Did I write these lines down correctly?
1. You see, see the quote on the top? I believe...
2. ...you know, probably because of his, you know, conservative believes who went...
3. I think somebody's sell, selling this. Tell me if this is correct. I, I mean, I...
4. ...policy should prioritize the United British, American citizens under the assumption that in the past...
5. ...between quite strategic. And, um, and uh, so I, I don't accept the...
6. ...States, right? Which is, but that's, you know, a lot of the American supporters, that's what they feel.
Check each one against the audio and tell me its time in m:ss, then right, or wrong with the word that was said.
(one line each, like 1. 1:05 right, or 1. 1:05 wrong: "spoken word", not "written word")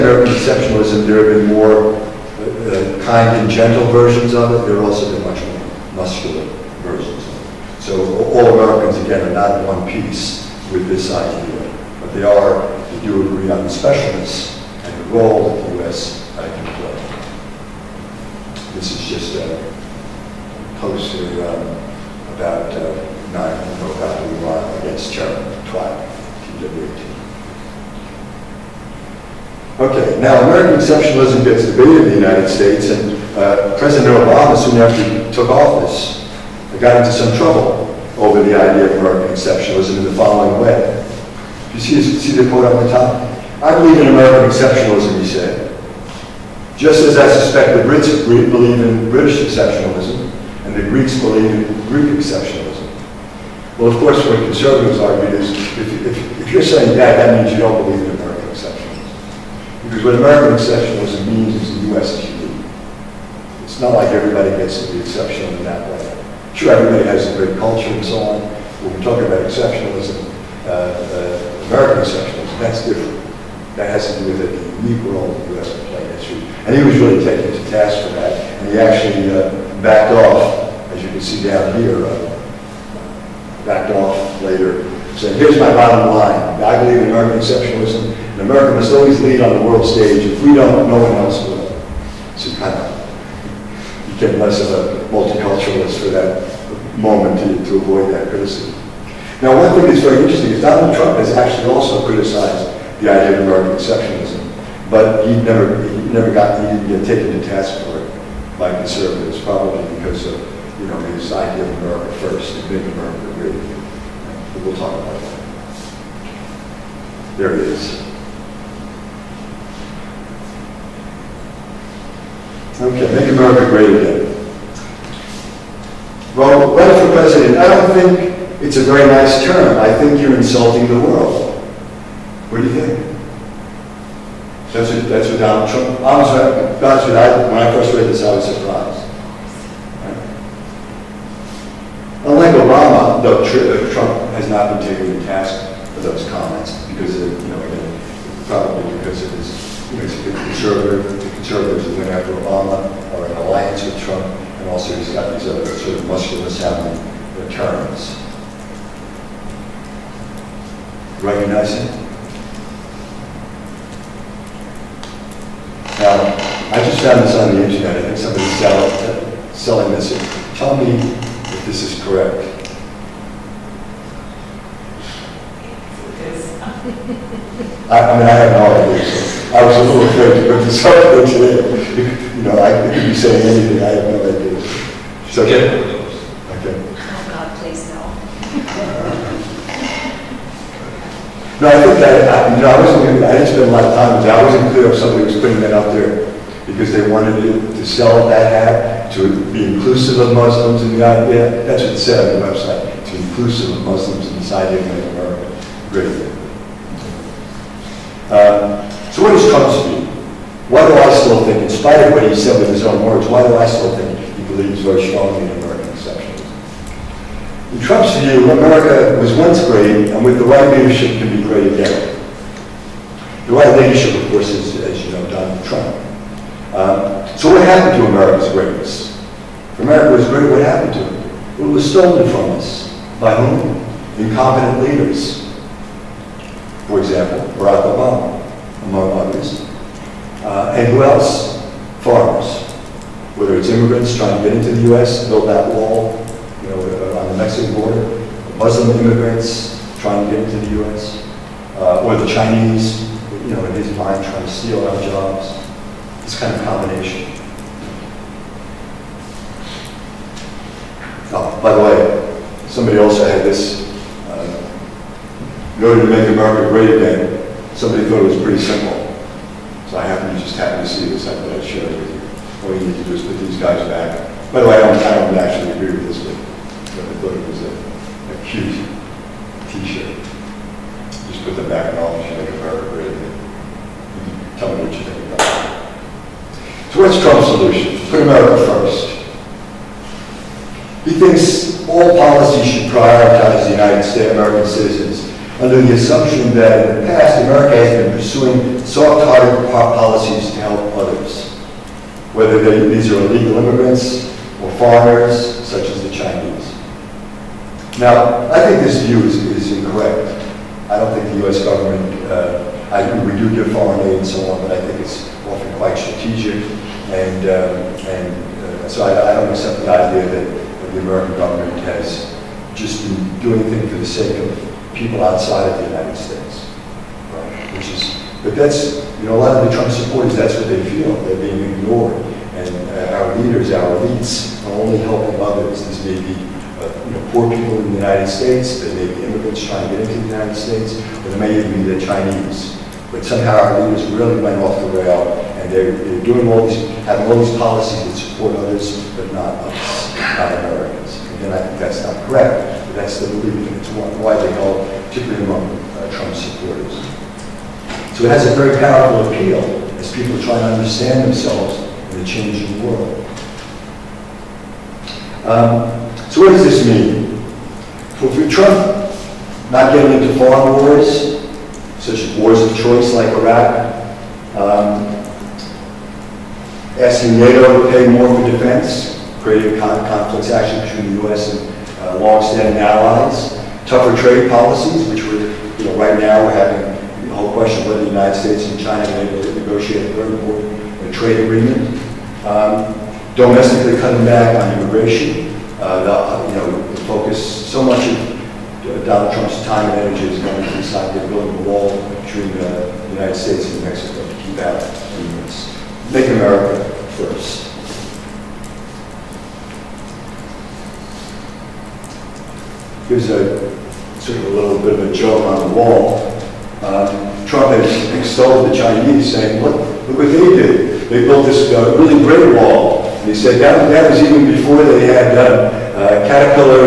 1. 0:41 right
2. 2:27 wrong: "conservatives", not "believes"
3. 2:47 right
4. 4:52 wrong: "States", not "British"
5. 5:15 wrong: "often", not "between"
6. 5:26 wrong: "Trump", not "American".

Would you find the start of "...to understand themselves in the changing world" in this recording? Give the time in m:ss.
6:00.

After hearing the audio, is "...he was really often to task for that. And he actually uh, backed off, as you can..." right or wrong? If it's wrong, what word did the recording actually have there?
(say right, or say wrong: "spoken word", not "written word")
wrong: "taken", not "often".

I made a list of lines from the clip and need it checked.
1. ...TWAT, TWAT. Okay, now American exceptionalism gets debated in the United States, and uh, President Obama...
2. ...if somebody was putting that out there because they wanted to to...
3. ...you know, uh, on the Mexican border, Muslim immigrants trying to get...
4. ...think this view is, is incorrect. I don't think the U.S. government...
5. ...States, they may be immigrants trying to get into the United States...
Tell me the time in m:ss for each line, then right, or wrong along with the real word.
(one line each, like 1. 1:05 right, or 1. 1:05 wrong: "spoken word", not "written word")
1. 0:25 right
2. 3:14 right
3. 4:06 right
4. 5:08 right
5. 5:38 right.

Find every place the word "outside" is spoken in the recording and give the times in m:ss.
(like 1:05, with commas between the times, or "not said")
5:25.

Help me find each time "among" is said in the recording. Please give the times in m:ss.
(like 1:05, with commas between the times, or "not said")
3:58, 5:55.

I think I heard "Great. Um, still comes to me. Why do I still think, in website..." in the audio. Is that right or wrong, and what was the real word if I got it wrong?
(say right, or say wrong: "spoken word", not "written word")
wrong: "spite", not "website".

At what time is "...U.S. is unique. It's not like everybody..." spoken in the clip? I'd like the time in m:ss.
1:01.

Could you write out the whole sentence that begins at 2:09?
I think you're insulting the world.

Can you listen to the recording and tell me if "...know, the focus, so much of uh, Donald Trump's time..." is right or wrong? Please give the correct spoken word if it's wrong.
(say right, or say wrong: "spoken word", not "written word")
right.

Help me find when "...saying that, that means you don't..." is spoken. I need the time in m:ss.
0:56.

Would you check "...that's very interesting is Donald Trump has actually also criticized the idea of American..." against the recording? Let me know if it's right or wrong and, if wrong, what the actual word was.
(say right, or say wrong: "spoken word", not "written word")
right.